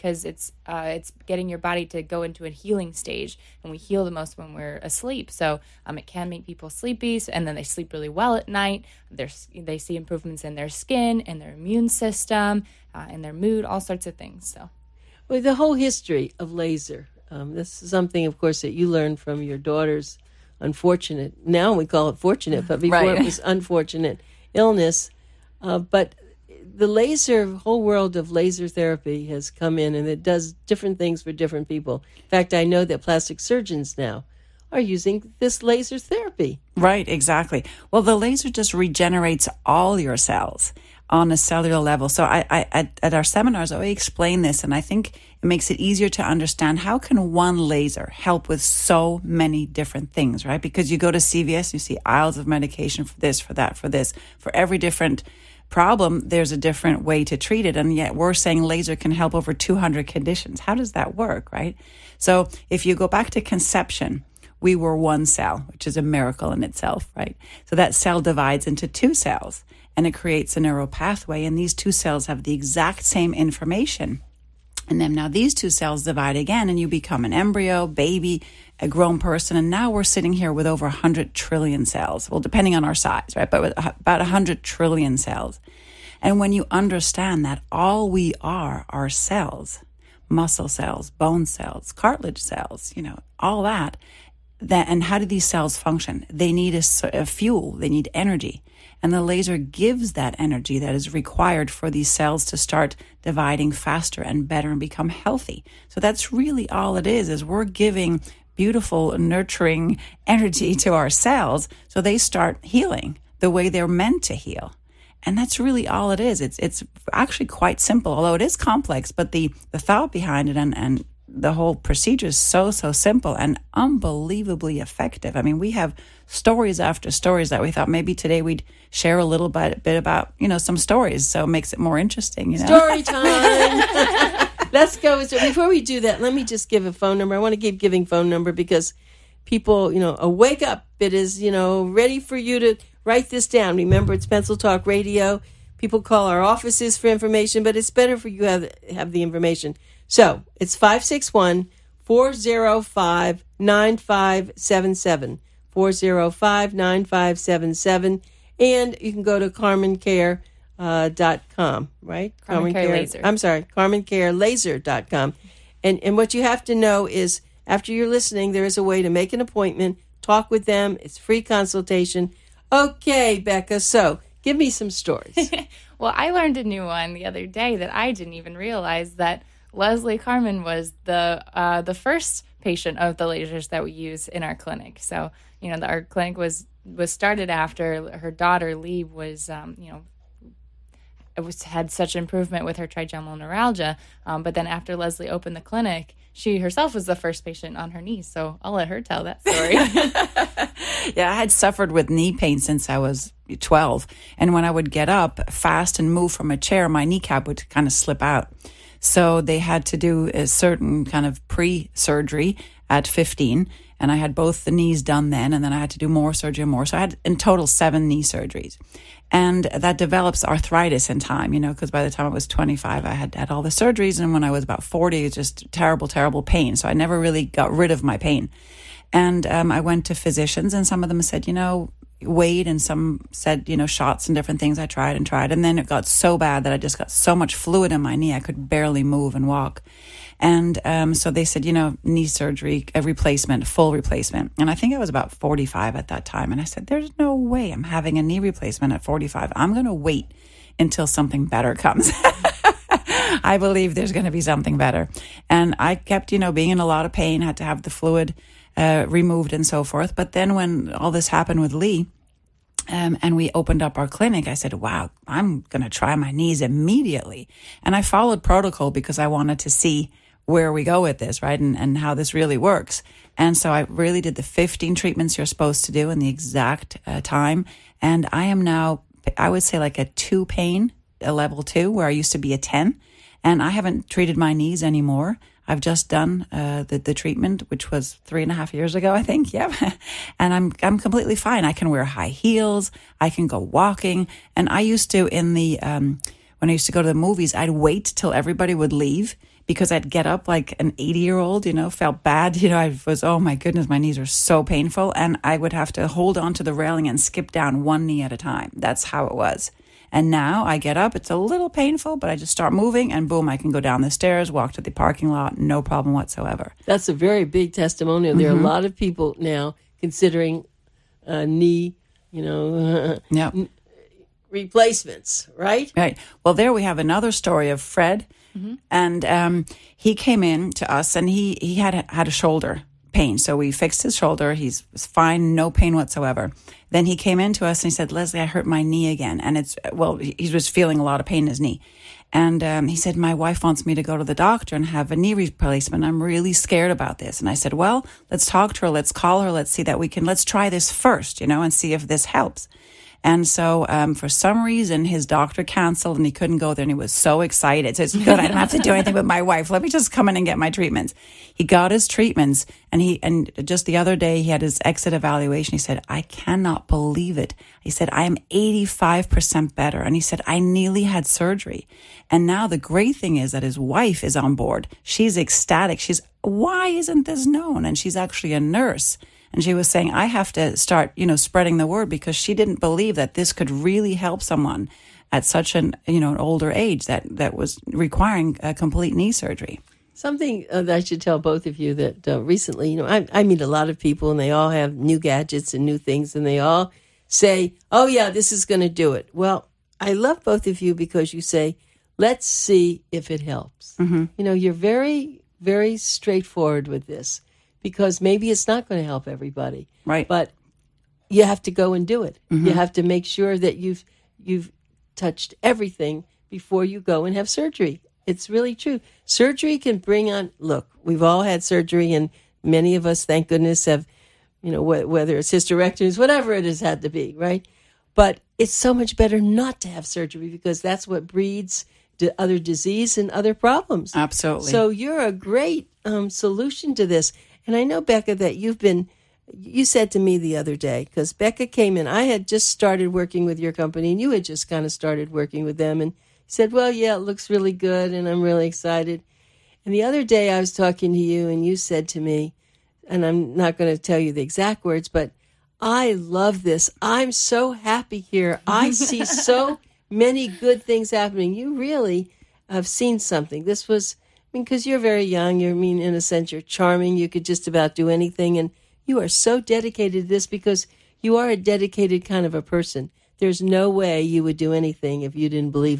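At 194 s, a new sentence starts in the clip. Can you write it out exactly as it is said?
Um, but then after Leslie opened the clinic, she herself was the first patient on her knee.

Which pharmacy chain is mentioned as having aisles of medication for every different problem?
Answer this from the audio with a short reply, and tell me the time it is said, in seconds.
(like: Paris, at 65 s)
CVS, at 51 s.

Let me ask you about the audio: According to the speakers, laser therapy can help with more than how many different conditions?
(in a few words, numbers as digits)
200.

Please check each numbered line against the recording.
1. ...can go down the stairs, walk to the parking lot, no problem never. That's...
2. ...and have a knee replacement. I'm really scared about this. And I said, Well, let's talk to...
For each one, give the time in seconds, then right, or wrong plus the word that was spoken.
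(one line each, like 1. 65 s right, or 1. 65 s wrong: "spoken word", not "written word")
1. 313 s wrong: "whatsoever", not "never"
2. 344 s right.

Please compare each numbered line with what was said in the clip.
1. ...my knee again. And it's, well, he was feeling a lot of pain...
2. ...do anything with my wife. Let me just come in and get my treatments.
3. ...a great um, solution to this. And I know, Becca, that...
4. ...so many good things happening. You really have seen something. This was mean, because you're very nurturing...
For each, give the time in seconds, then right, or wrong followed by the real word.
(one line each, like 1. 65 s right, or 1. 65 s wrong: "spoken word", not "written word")
1. 338 s right
2. 358 s right
3. 435 s right
4. 459 s wrong: "young", not "nurturing".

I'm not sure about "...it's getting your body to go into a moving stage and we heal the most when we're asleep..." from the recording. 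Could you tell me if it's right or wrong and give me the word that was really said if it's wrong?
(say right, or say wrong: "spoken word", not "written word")
wrong: "healing", not "moving".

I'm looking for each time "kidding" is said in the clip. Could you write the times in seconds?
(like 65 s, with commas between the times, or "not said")
not said.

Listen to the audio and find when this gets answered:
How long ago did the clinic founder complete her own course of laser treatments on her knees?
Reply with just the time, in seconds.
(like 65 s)
288 s.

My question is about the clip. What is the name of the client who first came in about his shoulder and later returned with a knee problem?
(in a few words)
Fred.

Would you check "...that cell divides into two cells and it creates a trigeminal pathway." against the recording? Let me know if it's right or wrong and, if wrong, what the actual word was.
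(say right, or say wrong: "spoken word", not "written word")
wrong: "neural", not "trigeminal".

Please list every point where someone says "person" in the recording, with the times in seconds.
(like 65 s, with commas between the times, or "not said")
79 s, 472 s.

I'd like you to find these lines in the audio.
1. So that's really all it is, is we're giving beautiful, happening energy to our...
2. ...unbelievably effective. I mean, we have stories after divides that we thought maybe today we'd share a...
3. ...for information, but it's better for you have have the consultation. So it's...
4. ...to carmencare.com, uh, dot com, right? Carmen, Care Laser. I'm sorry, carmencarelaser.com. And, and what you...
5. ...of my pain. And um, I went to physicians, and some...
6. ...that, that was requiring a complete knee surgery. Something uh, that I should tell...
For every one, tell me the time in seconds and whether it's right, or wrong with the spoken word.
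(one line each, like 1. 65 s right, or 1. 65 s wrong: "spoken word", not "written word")
1. 105 s wrong: "nurturing", not "happening"
2. 123 s wrong: "stories", not "divides"
3. 146 s wrong: "information", not "consultation"
4. 159 s right
5. 227 s right
6. 387 s right.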